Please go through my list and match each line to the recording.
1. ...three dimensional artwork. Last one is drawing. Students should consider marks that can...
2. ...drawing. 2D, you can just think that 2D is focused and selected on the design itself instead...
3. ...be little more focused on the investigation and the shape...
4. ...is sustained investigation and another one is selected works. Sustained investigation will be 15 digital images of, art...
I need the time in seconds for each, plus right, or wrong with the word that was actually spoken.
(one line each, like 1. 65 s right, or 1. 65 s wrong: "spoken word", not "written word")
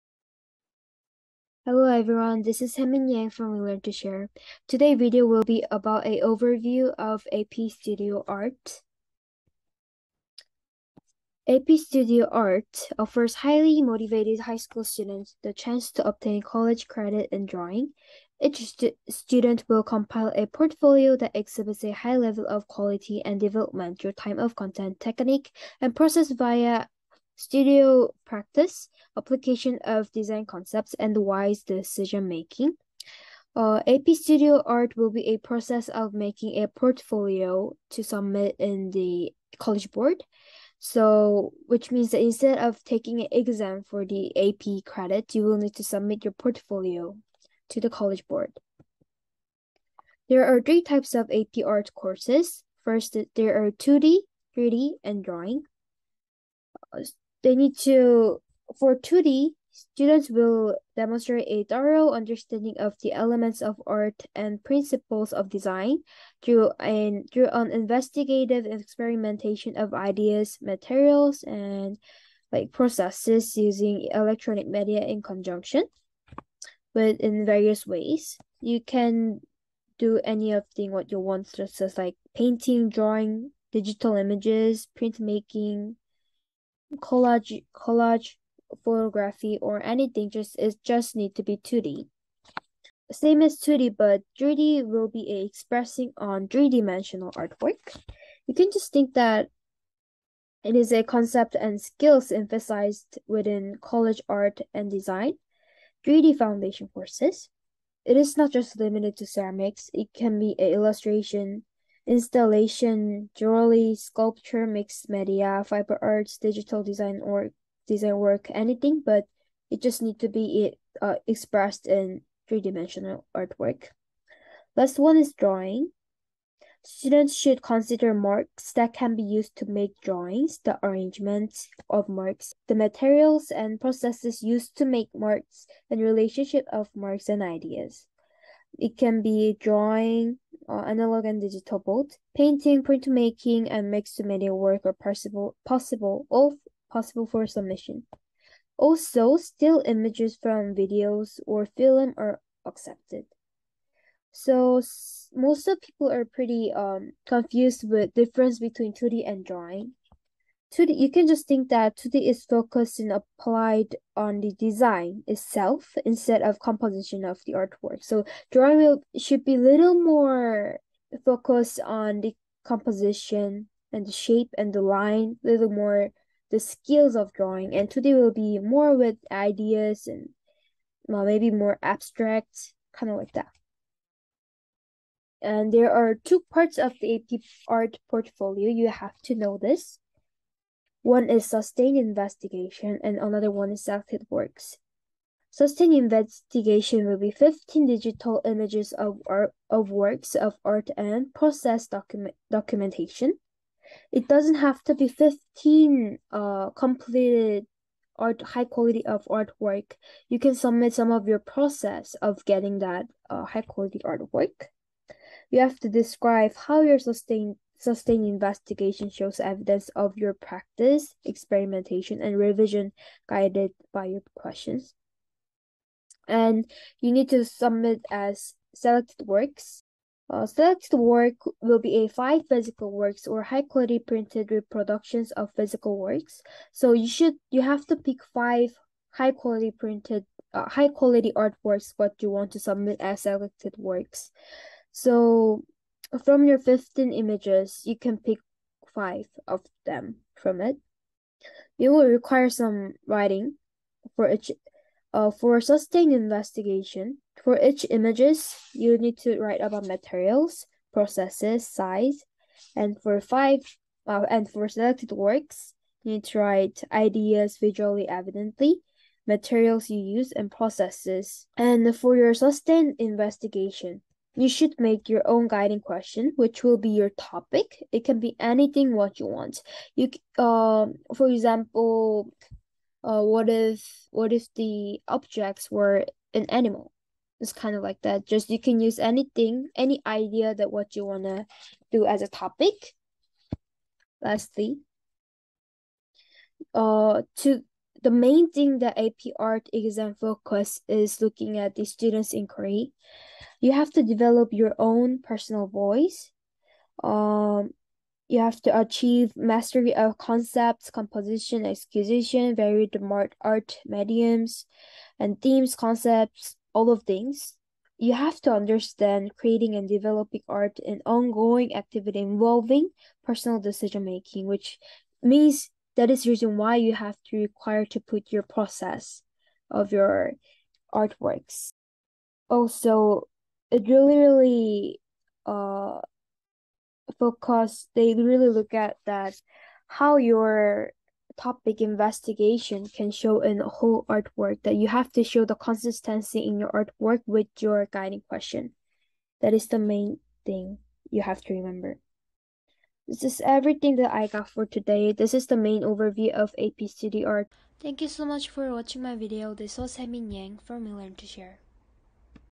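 1. 122 s right
2. 159 s wrong: "applied", not "selected"
3. 169 s wrong: "composition", not "investigation"
4. 191 s right.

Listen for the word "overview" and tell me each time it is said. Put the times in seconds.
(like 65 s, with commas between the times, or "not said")
6 s, 355 s.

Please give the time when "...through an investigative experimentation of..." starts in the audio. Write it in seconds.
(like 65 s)
67 s.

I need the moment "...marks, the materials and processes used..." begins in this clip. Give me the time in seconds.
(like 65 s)
132 s.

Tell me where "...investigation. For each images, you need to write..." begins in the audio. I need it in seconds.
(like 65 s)
256 s.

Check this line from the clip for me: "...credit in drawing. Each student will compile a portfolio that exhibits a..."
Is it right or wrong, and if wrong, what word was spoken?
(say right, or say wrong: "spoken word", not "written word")
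right.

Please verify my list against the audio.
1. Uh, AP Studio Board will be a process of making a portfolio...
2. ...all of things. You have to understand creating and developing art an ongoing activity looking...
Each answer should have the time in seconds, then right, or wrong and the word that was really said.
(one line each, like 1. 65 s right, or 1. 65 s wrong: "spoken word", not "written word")
1. 33 s wrong: "Art", not "Board"
2. 316 s wrong: "involving", not "looking".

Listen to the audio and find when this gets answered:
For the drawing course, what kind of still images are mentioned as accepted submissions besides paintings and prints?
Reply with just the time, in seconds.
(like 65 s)
149 s.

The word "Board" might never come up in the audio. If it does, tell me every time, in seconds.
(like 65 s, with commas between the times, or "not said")
39 s, 48 s.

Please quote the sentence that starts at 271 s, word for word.
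And for your sustained investigation, you should make your own guiding question, which will be your topic.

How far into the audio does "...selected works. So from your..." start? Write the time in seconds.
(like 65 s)
243 s.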